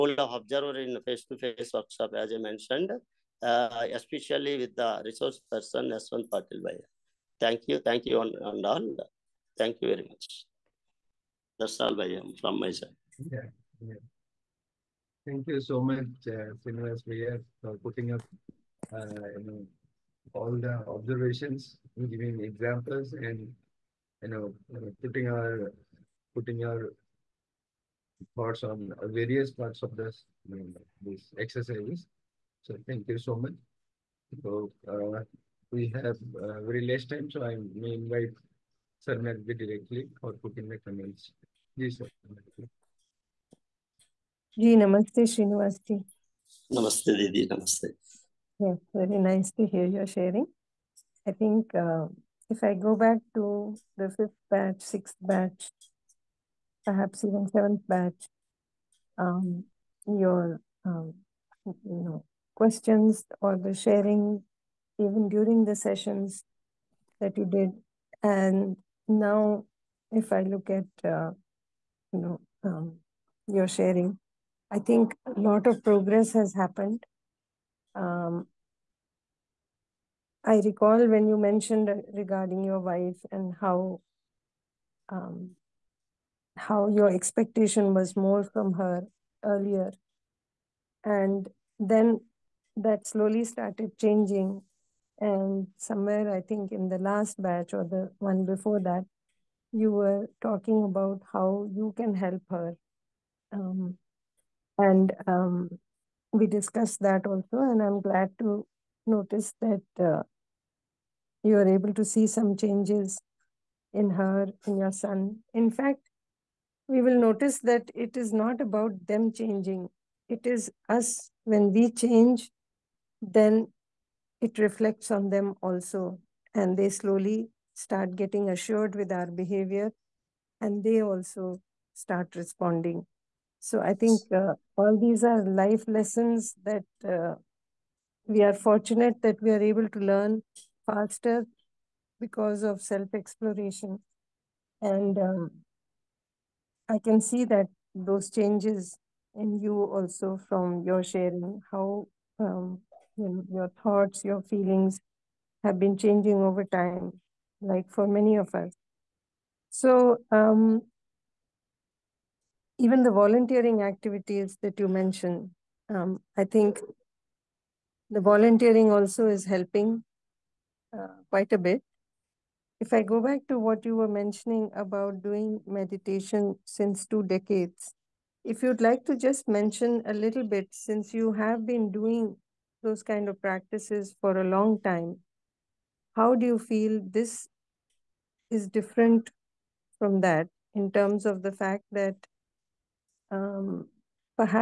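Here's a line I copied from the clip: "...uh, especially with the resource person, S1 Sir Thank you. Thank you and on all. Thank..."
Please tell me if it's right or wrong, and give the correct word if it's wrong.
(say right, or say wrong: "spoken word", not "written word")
wrong: "Patil", not "Sir".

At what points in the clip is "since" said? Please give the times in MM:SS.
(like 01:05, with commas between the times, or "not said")
02:56, 03:00.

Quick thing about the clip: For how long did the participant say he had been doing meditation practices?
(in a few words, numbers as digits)
two decades.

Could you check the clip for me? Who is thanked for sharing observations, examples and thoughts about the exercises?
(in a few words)
Srinivas.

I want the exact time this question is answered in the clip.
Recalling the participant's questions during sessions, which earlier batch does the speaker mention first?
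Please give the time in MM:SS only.
00:54.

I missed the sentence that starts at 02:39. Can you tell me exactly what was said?
So, um, even the volunteering activities that you mentioned, um, I think the volunteering also is helping uh, quite a bit.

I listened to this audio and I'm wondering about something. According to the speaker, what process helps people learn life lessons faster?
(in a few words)
self exploration.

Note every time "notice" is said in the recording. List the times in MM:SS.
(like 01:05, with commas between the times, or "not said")
01:49, 01:57.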